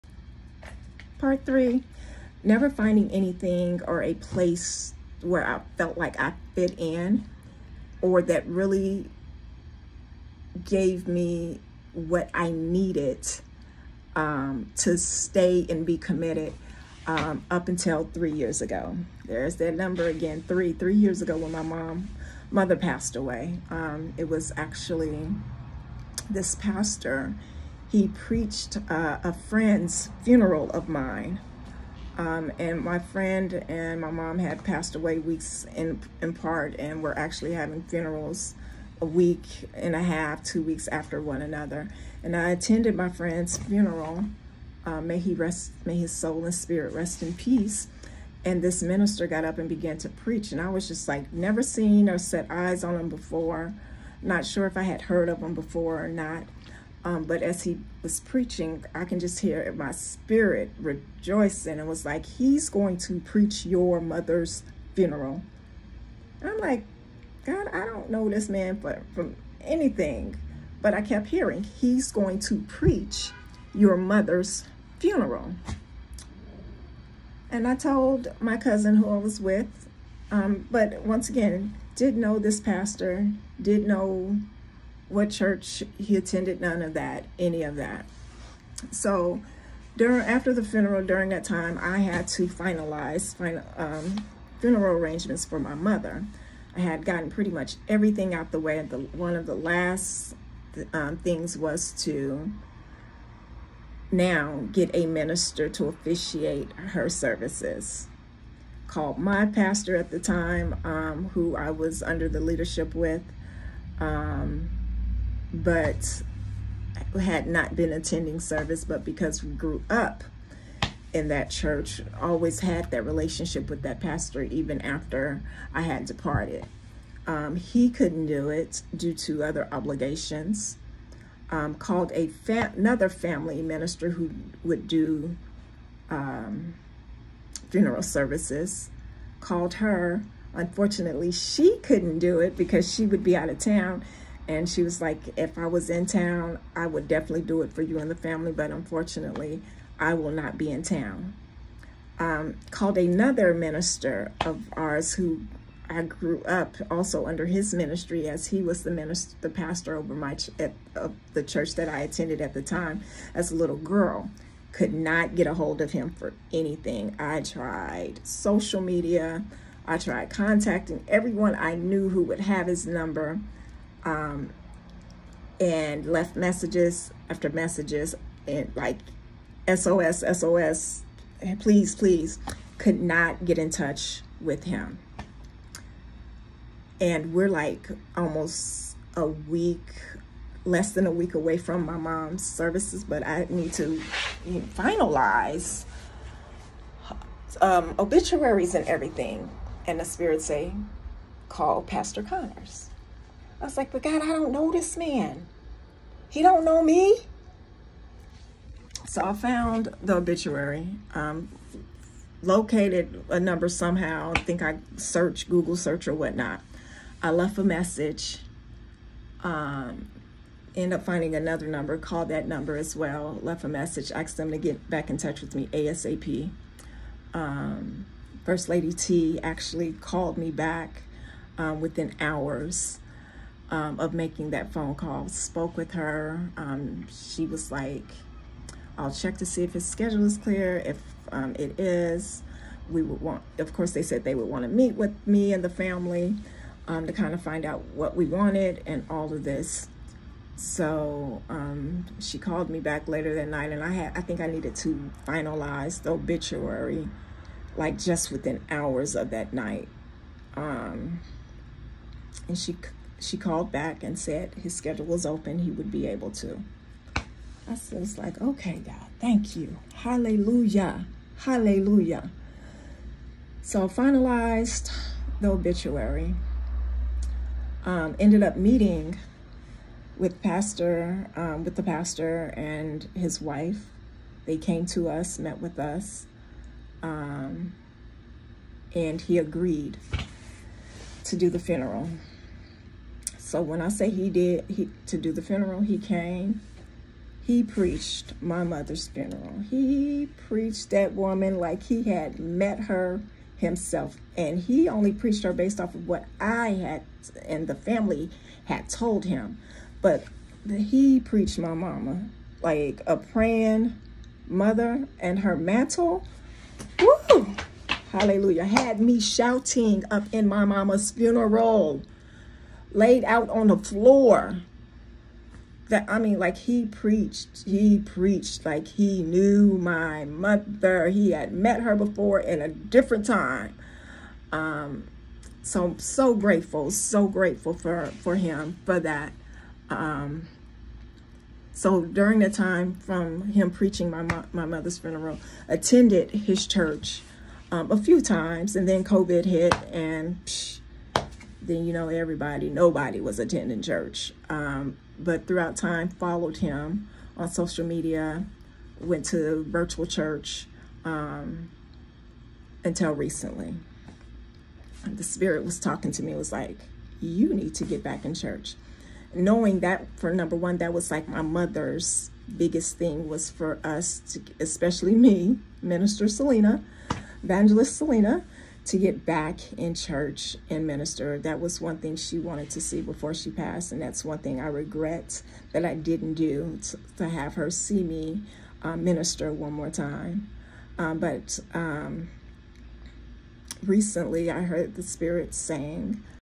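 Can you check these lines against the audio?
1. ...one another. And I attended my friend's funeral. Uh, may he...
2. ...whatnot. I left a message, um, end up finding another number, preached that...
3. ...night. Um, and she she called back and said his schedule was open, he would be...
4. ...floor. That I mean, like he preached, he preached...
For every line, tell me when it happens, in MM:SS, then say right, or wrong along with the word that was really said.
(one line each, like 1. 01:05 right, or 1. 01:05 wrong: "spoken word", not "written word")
1. 00:41 right
2. 03:36 wrong: "called", not "preached"
3. 04:19 right
4. 05:23 right.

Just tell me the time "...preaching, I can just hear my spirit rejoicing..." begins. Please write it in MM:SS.
00:58.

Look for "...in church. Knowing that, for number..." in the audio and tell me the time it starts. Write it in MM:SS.
06:08.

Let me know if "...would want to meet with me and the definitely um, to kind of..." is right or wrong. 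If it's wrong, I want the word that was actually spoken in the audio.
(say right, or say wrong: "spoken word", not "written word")
wrong: "family", not "definitely".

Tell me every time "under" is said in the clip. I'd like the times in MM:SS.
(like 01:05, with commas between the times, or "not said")
01:52, 02:37.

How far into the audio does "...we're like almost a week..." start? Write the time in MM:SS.
03:07.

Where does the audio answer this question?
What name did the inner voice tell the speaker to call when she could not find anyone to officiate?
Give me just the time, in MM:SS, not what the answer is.
03:21.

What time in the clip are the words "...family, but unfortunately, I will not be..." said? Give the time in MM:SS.
02:28.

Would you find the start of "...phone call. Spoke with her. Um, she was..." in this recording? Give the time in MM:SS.
03:54.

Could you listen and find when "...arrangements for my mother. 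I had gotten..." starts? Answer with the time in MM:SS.
01:34.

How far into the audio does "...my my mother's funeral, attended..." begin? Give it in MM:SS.
05:44.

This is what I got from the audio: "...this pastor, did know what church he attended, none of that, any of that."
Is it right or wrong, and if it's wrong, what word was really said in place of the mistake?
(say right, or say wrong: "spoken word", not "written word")
right.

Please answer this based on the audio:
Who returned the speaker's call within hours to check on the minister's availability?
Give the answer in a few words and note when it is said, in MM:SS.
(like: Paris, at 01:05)
First Lady T, at 03:48.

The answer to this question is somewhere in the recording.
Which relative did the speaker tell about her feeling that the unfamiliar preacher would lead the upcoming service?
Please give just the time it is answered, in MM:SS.
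01:18.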